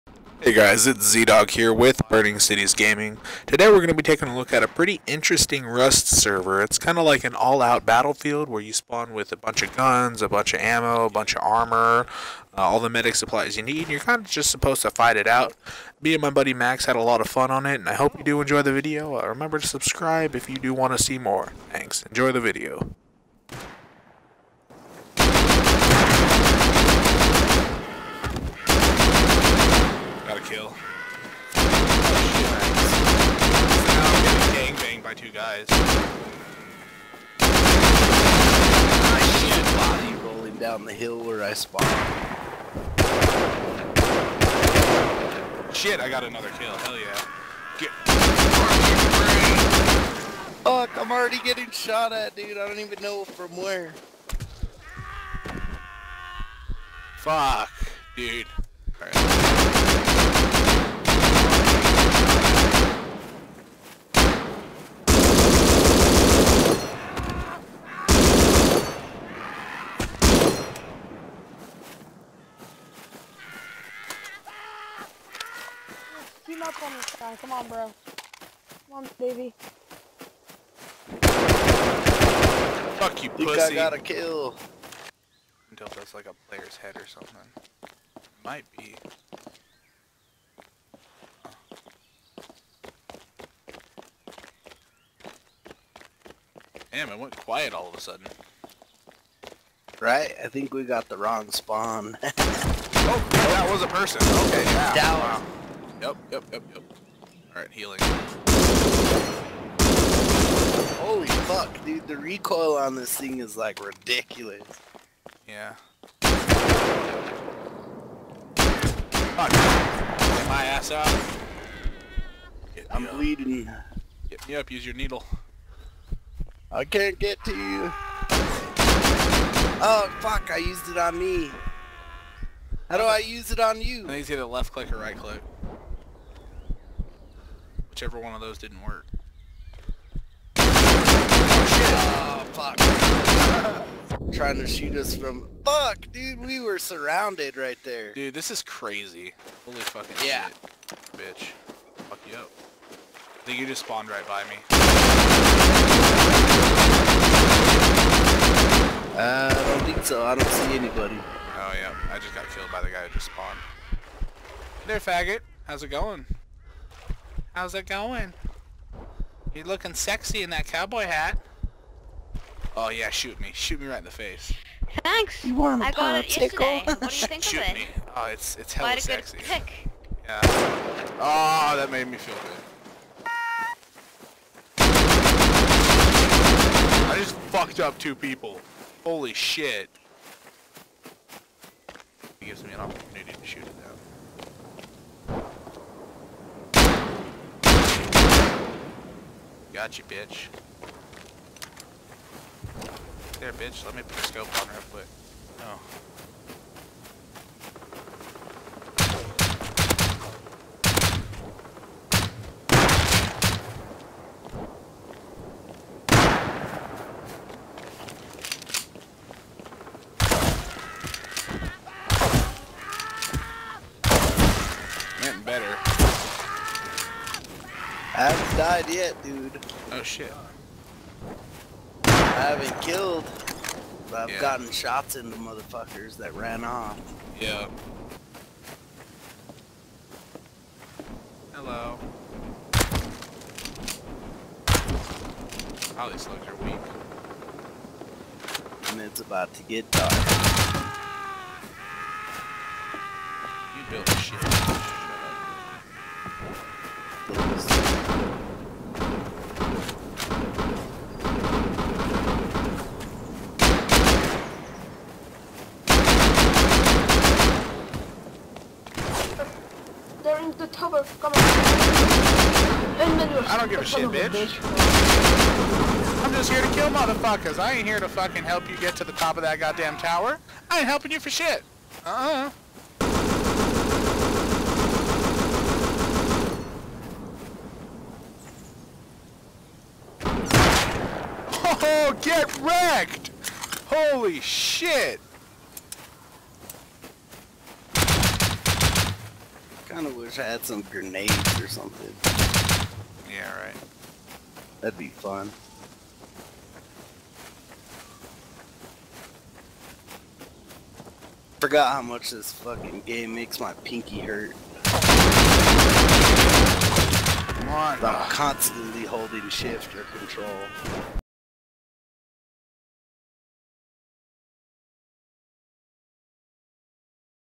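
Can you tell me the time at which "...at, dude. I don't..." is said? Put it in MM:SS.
00:52.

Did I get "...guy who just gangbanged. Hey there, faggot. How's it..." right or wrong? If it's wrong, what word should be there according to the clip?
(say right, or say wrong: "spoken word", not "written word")
wrong: "spawned", not "gangbanged".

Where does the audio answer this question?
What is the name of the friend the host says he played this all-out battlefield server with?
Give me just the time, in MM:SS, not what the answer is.
00:16.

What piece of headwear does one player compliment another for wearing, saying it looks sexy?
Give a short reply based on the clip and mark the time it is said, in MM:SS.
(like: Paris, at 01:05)
Cowboy hat, at 02:50.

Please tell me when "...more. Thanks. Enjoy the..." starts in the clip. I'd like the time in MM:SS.
00:21.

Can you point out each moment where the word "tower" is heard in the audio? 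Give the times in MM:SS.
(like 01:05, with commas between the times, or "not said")
04:39.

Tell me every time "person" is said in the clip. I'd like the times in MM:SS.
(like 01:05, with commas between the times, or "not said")
01:43.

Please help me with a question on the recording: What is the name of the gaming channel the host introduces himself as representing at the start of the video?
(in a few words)
Burning Cities Gaming.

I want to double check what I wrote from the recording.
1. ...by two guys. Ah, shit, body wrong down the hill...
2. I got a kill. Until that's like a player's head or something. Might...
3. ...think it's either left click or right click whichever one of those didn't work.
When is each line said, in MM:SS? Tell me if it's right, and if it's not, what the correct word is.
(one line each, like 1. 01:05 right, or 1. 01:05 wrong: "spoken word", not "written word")
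1. 00:35 wrong: "rolling", not "wrong"
2. 01:23 right
3. 02:14 right.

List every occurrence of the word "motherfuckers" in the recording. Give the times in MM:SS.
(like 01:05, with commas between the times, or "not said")
03:55, 04:36.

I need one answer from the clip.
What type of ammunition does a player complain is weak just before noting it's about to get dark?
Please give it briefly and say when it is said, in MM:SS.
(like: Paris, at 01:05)
Slugs, at 04:06.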